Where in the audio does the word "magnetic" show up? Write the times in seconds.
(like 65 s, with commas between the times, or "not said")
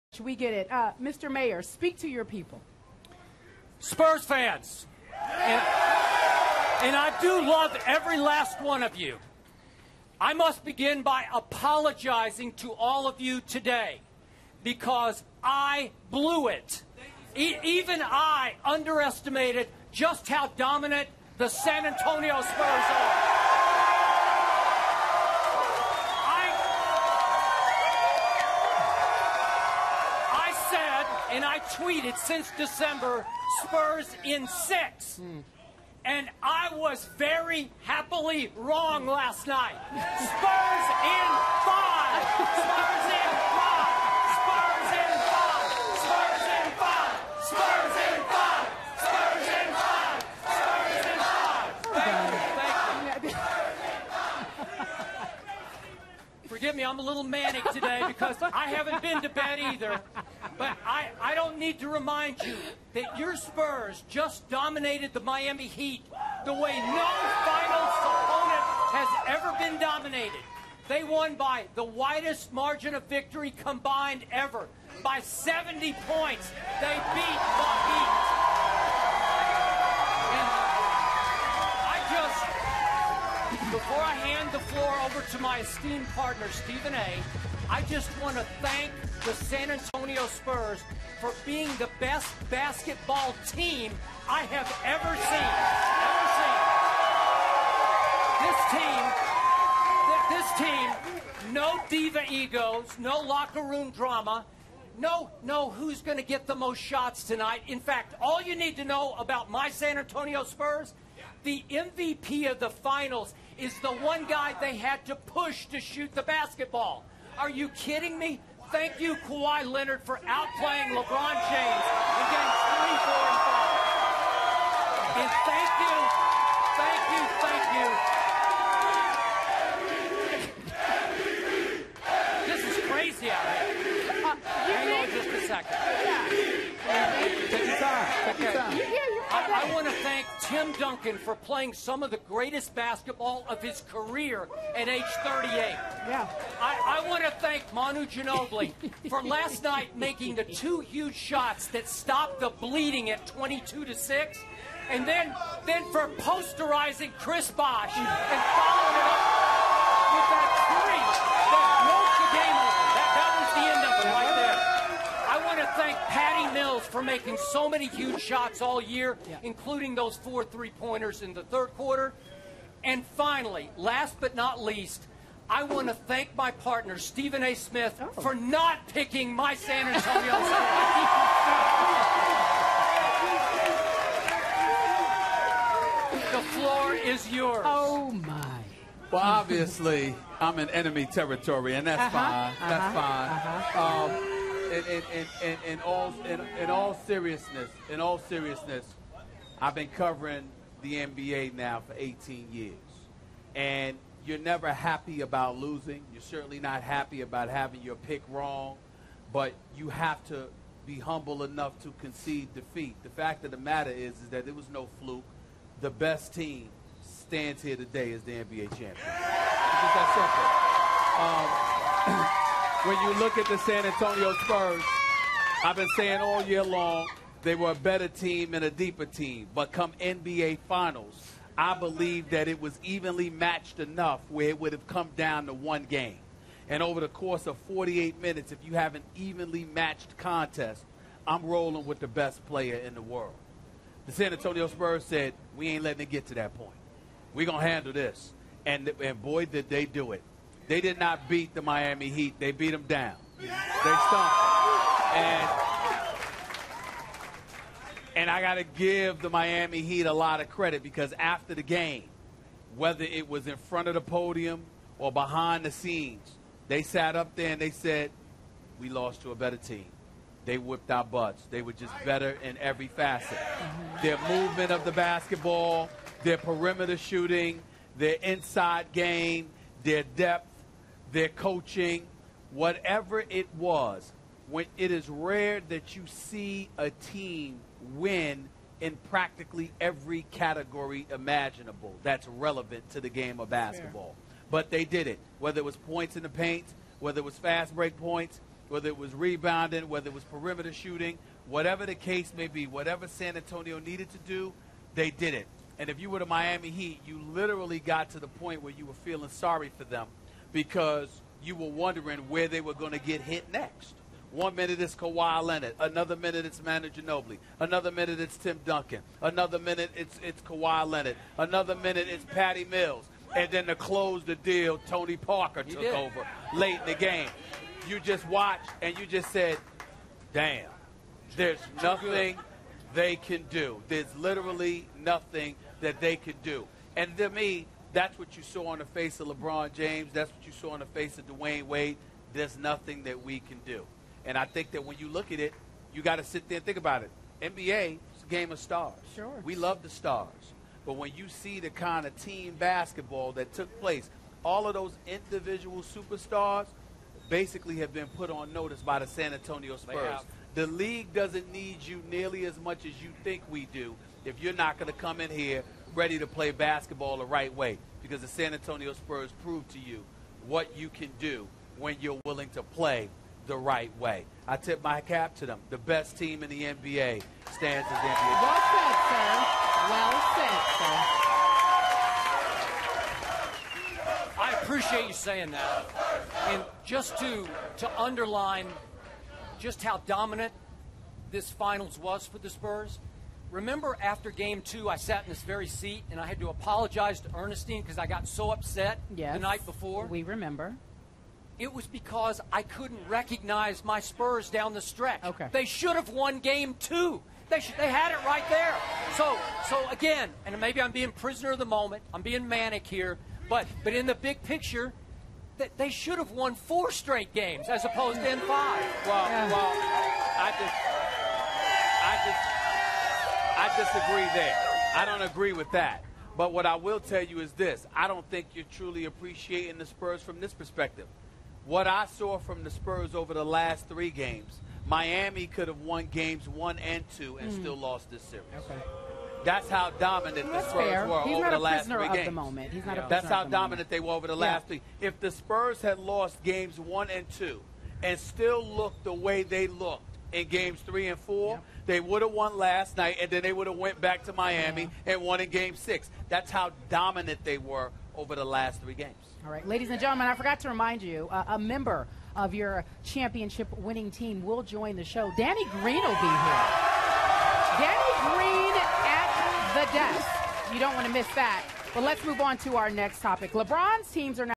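not said.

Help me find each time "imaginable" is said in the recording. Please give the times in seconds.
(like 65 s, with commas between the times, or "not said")
291 s.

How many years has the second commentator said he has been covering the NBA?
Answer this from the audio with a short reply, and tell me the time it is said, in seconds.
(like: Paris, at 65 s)
18, at 201 s.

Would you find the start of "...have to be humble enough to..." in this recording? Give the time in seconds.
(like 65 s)
209 s.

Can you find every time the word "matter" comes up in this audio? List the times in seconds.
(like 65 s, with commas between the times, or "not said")
213 s.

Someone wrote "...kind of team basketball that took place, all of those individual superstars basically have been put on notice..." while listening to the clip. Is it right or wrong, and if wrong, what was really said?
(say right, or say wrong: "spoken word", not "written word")
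right.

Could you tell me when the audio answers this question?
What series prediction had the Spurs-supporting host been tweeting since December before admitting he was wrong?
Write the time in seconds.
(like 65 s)
33 s.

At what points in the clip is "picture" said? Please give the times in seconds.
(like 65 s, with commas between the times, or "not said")
414 s.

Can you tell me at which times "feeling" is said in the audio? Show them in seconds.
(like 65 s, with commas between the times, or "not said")
308 s.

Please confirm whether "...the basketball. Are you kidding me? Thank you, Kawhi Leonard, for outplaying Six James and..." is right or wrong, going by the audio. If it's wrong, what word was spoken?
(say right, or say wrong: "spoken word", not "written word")
wrong: "LeBron", not "Six".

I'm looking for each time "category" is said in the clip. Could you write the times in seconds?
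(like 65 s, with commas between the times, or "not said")
290 s.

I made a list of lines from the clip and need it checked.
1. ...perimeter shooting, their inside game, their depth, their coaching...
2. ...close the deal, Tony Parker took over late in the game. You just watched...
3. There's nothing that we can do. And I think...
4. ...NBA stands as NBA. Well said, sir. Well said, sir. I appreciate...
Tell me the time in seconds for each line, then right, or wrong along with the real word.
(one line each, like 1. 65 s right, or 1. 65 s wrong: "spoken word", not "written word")
1. 276 s right
2. 323 s right
3. 342 s right
4. 376 s right.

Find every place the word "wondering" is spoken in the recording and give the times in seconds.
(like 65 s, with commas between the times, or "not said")
311 s.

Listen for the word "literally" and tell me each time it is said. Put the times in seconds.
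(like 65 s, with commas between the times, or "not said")
307 s, 334 s.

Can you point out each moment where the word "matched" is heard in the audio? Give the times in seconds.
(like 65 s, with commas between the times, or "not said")
233 s, 239 s.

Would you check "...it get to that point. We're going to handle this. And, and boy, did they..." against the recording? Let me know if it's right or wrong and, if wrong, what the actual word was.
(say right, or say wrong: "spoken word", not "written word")
right.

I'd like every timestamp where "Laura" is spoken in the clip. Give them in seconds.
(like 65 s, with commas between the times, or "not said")
not said.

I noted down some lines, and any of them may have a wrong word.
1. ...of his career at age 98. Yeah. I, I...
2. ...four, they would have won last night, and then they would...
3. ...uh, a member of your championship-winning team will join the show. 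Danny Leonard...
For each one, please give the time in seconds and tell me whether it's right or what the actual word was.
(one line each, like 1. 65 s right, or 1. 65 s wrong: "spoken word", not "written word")
1. 143 s wrong: "38", not "98"
2. 451 s right
3. 461 s wrong: "Green", not "Leonard".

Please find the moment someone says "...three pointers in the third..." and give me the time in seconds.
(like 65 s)
170 s.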